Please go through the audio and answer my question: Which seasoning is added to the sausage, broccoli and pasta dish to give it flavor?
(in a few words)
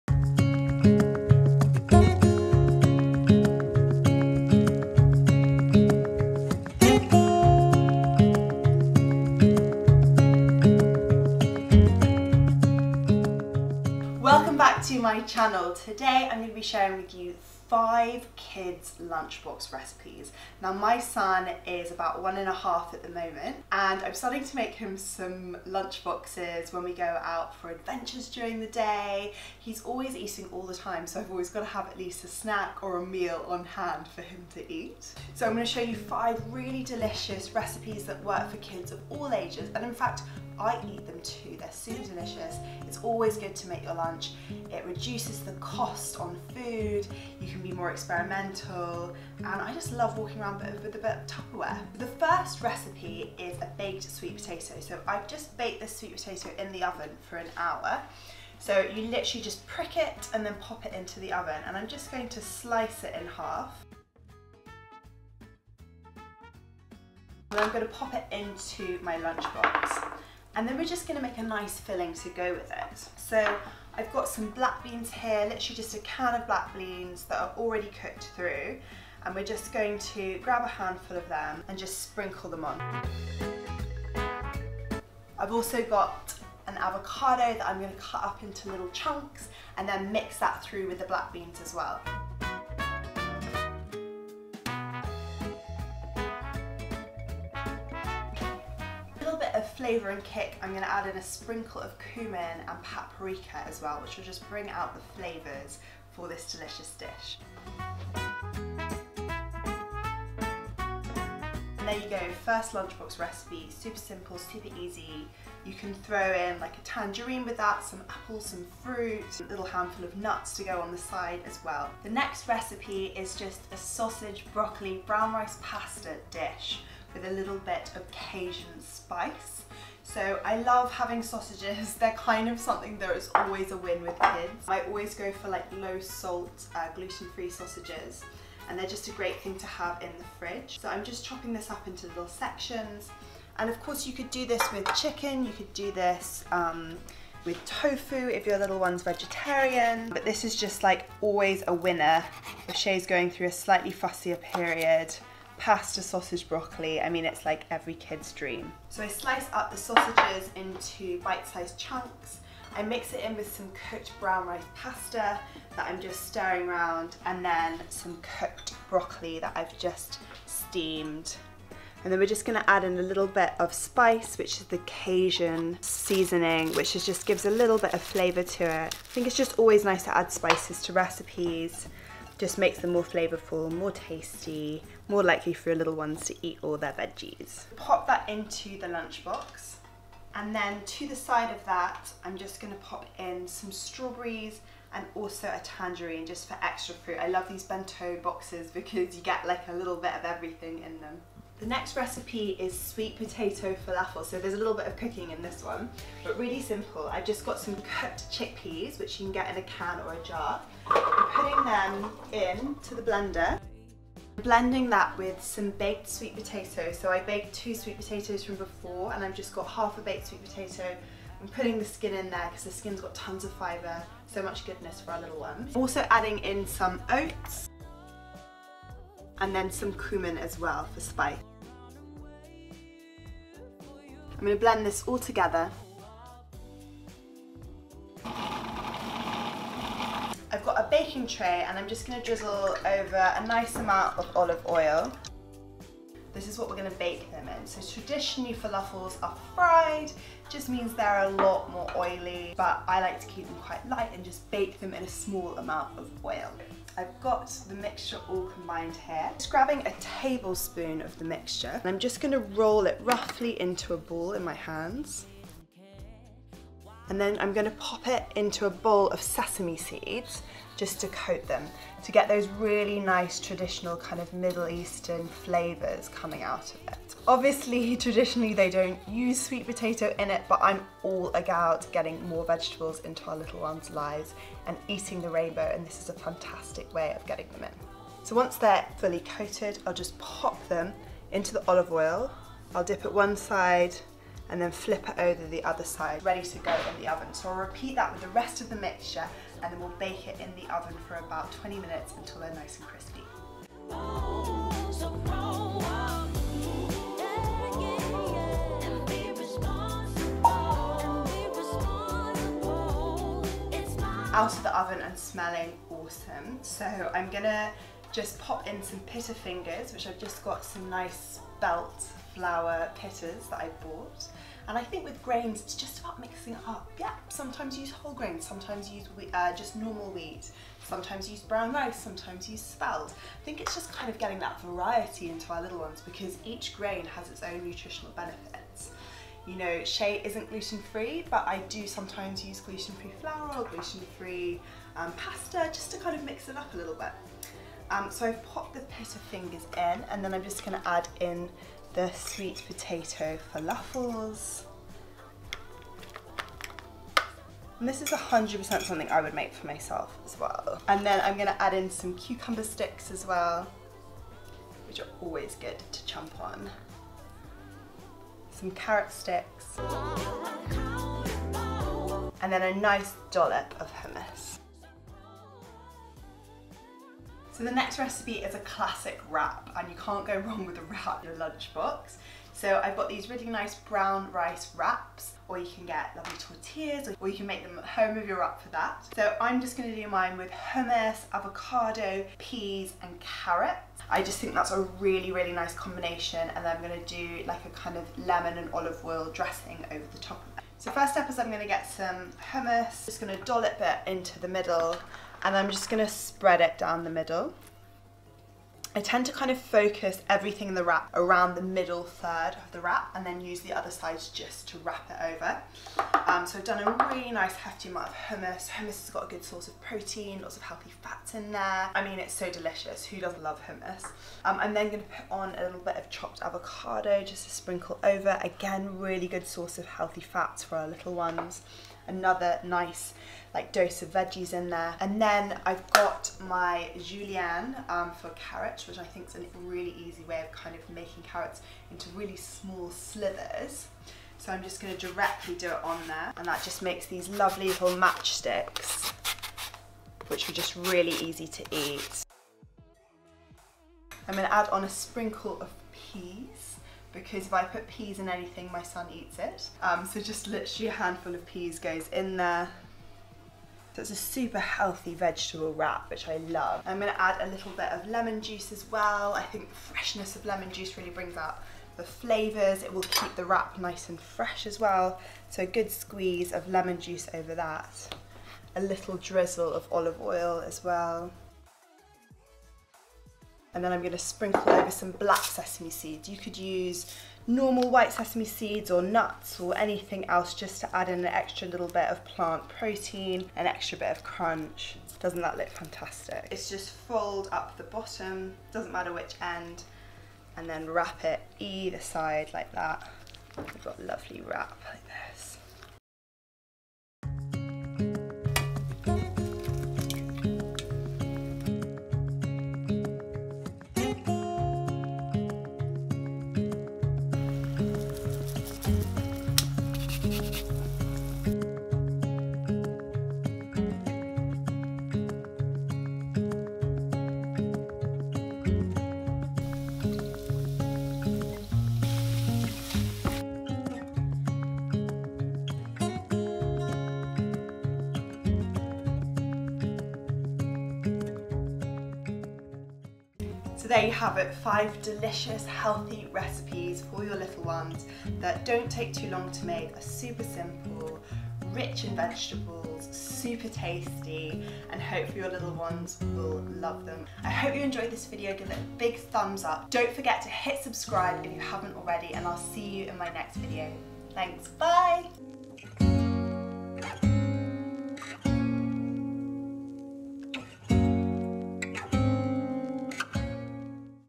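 Cajun seasoning.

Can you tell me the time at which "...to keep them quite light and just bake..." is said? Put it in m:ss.
4:13.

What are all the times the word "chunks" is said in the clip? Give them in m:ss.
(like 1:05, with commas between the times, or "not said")
1:28, 2:41.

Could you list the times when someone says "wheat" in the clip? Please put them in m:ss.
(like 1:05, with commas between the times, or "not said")
5:30.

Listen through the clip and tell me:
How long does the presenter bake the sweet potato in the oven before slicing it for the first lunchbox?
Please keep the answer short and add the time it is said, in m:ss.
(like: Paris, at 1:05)
An hour, at 0:57.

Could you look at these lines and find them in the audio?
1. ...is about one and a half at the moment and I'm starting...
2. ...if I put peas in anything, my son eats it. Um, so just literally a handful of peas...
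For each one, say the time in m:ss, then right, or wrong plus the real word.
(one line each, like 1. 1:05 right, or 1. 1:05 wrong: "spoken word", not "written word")
1. 0:21 right
2. 7:37 right.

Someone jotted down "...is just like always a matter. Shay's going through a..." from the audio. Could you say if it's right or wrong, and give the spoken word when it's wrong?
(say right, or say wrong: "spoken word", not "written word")
wrong: "winner", not "matter".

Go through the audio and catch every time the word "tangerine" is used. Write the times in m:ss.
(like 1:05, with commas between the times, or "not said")
1:56, 3:15.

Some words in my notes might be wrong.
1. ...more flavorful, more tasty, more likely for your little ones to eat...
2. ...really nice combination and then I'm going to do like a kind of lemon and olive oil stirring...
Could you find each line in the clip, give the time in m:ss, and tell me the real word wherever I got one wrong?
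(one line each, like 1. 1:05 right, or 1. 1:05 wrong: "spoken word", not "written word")
1. 3:02 right
2. 6:35 wrong: "dressing", not "stirring".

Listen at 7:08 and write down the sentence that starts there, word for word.
Again, really good source of healthy fats for our little ones another nice like dose of veggies in there.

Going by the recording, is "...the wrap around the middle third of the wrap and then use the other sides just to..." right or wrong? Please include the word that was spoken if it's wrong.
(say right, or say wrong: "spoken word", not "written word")
right.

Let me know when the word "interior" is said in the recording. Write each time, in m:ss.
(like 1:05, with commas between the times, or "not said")
not said.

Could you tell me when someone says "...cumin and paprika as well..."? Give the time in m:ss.
1:42.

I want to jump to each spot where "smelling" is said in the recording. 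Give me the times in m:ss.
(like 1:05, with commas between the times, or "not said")
5:15.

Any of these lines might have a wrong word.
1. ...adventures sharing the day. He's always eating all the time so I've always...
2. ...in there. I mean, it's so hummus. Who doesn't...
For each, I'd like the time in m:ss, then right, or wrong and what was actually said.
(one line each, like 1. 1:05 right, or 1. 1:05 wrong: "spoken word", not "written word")
1. 0:27 wrong: "during", not "sharing"
2. 7:01 wrong: "delicious", not "hummus".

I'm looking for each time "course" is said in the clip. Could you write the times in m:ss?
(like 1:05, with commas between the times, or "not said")
2:23.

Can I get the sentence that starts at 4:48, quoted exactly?
So once they're fully coated, I'll just pop them into the olive oil.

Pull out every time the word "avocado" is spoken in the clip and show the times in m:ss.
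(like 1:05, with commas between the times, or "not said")
1:26, 6:31, 7:06.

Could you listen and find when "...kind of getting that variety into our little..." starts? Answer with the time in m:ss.
5:33.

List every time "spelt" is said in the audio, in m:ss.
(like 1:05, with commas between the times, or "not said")
5:21, 5:32.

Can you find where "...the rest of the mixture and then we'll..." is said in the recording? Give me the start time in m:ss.
4:58.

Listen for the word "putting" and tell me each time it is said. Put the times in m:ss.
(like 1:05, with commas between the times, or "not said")
3:31, 3:41.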